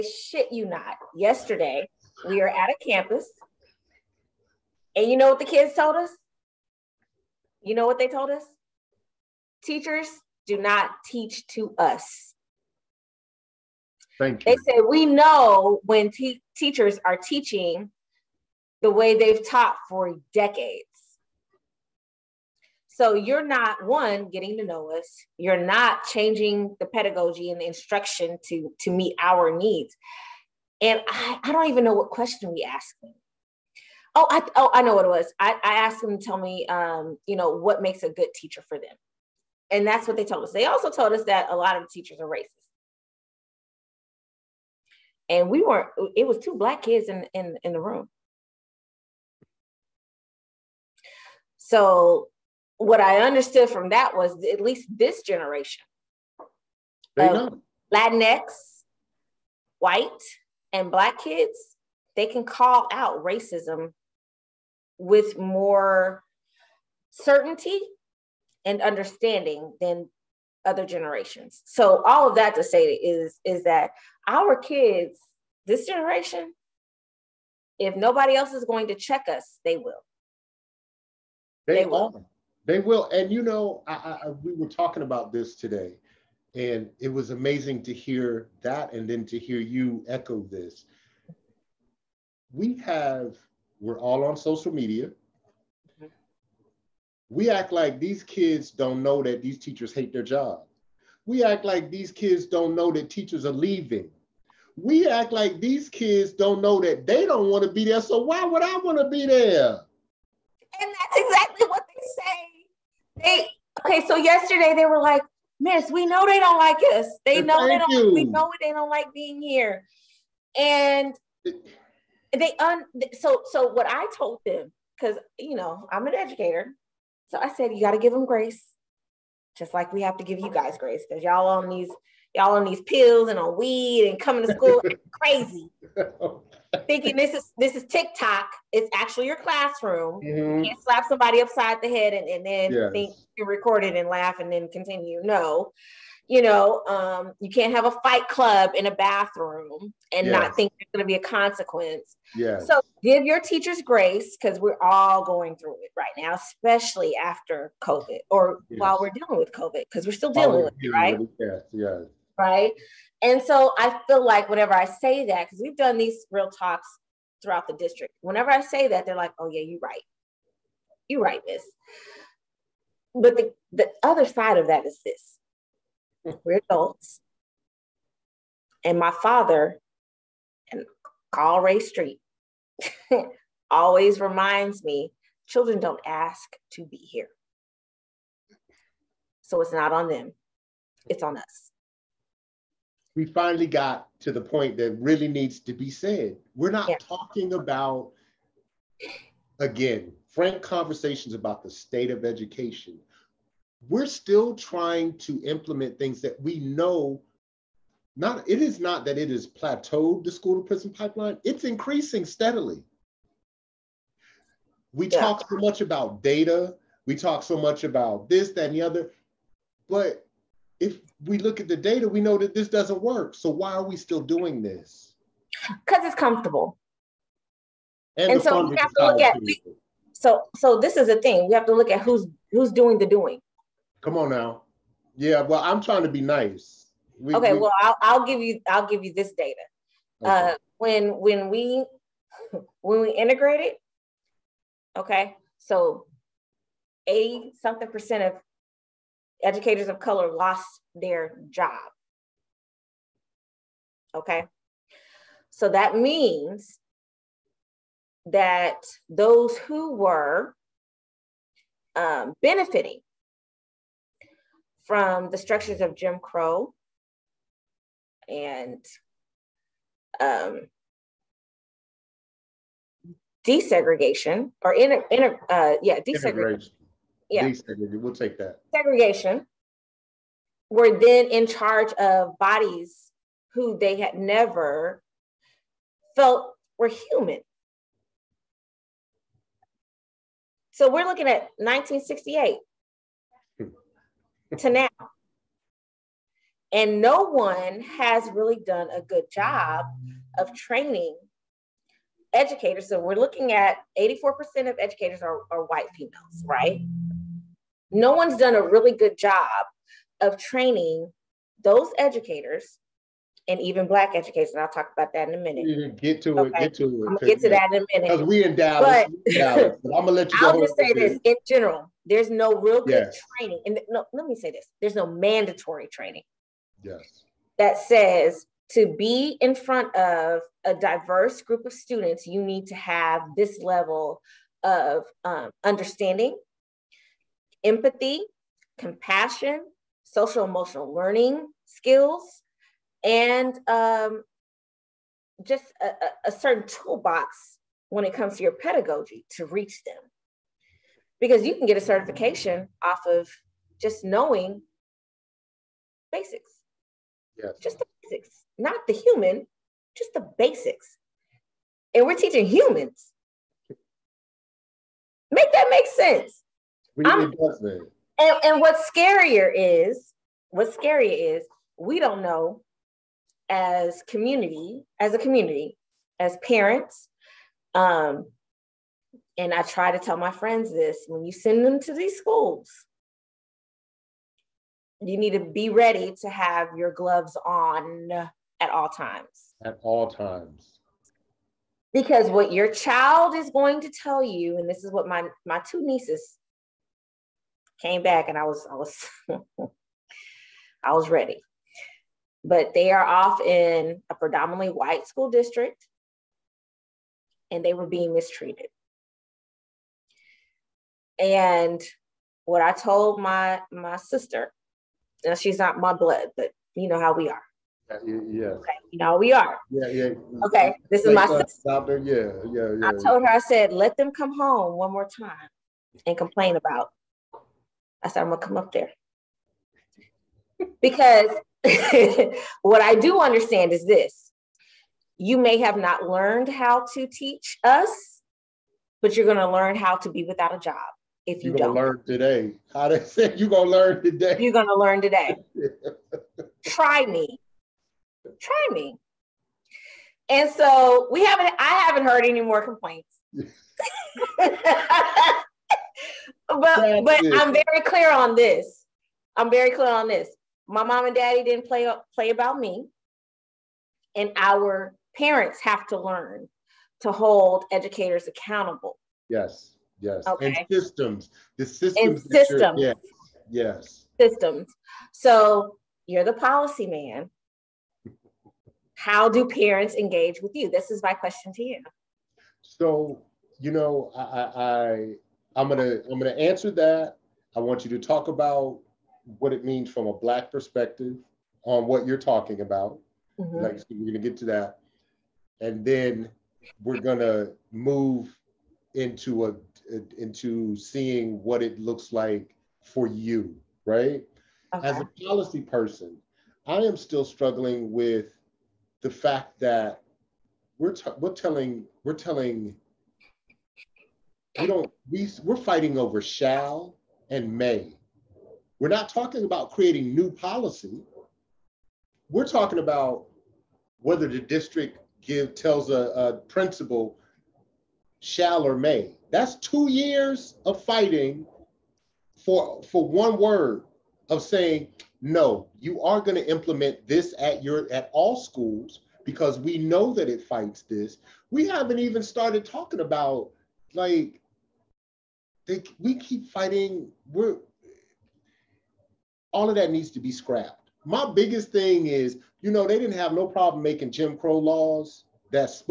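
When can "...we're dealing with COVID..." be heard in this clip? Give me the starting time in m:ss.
2:39.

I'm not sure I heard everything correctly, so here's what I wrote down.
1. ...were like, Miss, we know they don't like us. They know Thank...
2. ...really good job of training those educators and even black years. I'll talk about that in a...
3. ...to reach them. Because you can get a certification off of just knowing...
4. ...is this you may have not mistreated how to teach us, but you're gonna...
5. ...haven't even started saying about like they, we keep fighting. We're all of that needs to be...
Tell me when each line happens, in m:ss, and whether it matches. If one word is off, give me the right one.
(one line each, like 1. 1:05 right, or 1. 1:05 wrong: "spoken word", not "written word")
1. 1:54 right
2. 5:08 wrong: "educators", not "years"
3. 5:49 right
4. 7:13 wrong: "learned", not "mistreated"
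5. 9:01 wrong: "talking", not "saying".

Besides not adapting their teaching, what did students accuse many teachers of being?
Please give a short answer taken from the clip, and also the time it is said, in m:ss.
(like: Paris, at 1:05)
Racist, at 0:42.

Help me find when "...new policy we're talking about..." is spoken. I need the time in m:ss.
8:40.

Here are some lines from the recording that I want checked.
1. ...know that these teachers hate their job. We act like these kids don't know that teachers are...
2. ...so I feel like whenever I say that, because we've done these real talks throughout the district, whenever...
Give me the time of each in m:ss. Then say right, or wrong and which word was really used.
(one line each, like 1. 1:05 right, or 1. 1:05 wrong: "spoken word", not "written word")
1. 1:39 right
2. 2:43 right.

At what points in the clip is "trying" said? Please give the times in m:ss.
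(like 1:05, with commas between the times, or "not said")
3:24, 3:55.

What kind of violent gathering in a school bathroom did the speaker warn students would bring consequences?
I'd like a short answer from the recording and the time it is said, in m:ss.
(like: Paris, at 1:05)
Fight club, at 2:28.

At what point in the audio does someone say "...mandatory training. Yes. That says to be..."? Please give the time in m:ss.
5:25.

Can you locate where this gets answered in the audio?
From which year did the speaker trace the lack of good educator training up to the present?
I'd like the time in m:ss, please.
4:51.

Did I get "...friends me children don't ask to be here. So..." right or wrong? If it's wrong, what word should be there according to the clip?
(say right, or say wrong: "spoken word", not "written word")
wrong: "reminds", not "friends".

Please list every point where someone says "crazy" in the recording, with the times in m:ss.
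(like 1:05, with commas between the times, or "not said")
2:15.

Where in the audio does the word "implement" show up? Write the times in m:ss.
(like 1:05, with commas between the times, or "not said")
3:25, 8:56.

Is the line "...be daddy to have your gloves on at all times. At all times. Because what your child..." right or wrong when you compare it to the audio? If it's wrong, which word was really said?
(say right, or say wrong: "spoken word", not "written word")
wrong: "ready", not "daddy".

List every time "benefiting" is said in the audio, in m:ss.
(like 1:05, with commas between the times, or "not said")
4:22.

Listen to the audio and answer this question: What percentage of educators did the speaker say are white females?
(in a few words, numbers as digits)
84%.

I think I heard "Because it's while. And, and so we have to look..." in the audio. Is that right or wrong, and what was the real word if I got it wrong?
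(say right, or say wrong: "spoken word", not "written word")
wrong: "comfortable", not "while".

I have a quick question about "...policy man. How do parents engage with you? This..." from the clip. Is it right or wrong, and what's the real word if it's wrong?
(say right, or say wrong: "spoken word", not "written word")
right.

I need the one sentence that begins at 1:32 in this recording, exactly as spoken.
We have, we're all on social media.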